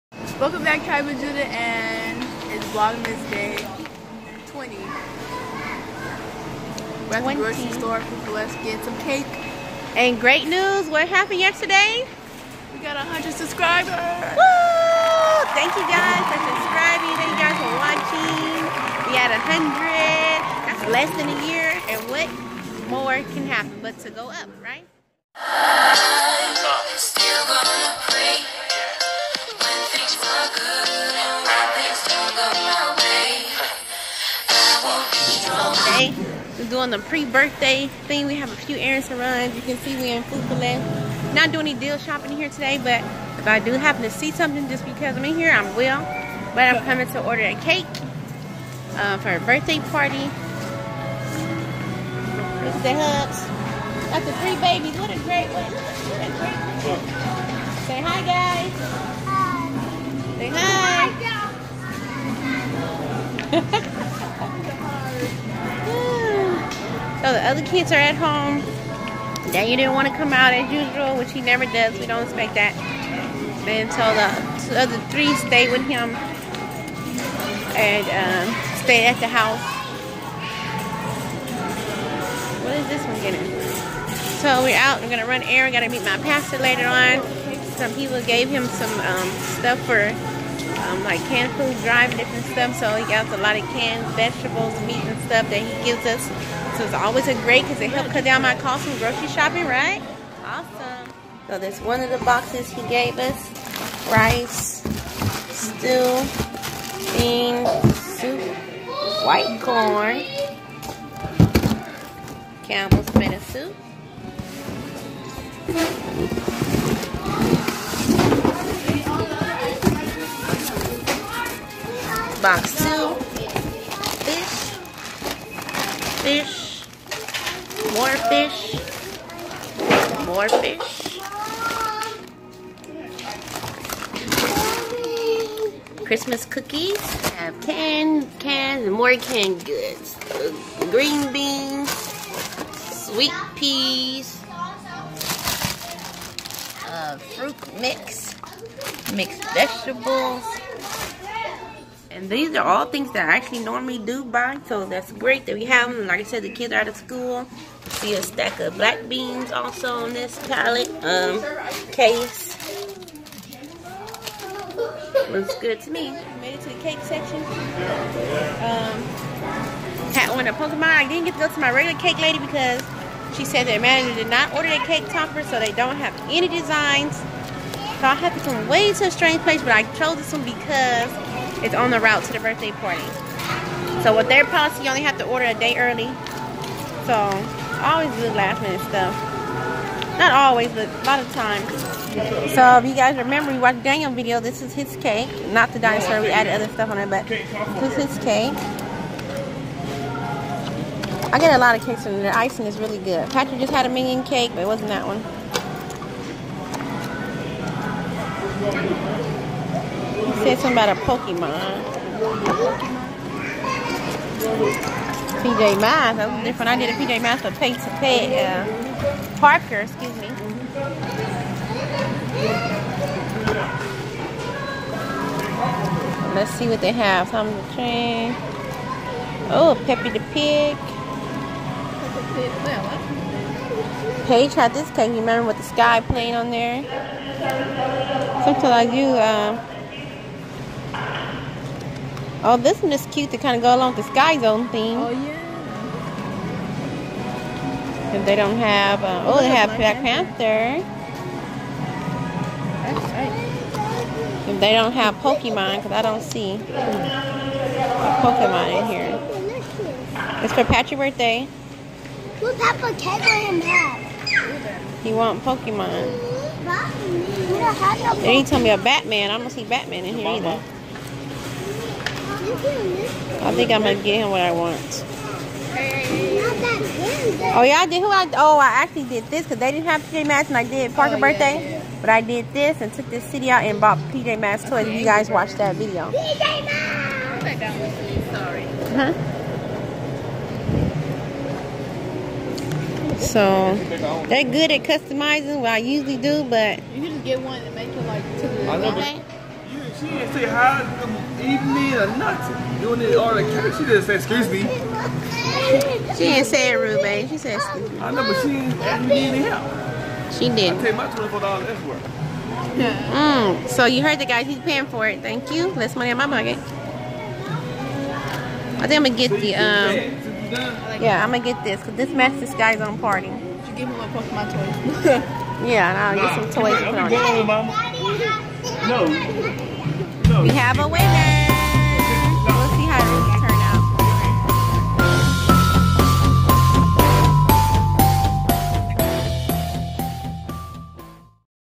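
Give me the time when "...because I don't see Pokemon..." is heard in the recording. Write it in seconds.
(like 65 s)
255 s.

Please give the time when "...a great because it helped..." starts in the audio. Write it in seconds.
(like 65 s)
97 s.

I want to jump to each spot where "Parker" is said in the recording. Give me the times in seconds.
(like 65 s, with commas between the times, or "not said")
219 s, 280 s.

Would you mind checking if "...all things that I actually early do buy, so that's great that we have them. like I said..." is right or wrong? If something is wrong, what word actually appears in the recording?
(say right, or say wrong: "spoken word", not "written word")
wrong: "normally", not "early".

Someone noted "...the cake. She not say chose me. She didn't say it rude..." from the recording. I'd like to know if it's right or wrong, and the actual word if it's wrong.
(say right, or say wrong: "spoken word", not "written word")
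wrong: "excuse", not "chose".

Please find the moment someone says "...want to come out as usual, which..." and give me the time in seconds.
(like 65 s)
69 s.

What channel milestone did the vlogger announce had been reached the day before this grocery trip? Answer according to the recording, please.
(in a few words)
100 subscribers.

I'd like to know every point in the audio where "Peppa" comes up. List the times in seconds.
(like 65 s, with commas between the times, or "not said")
229 s.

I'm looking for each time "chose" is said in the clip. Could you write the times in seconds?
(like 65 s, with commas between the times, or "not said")
179 s.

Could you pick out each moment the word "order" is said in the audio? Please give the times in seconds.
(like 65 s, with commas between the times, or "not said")
47 s, 174 s, 185 s.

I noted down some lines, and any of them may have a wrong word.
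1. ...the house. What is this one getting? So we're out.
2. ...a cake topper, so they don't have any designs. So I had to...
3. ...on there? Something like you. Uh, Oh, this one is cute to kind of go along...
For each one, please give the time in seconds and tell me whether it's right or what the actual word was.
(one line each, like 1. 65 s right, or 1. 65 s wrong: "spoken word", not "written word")
1. 79 s right
2. 174 s right
3. 236 s right.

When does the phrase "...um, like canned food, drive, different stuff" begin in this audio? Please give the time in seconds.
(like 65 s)
90 s.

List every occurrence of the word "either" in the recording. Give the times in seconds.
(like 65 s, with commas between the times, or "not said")
270 s.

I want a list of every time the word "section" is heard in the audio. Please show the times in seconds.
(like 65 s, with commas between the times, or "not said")
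167 s.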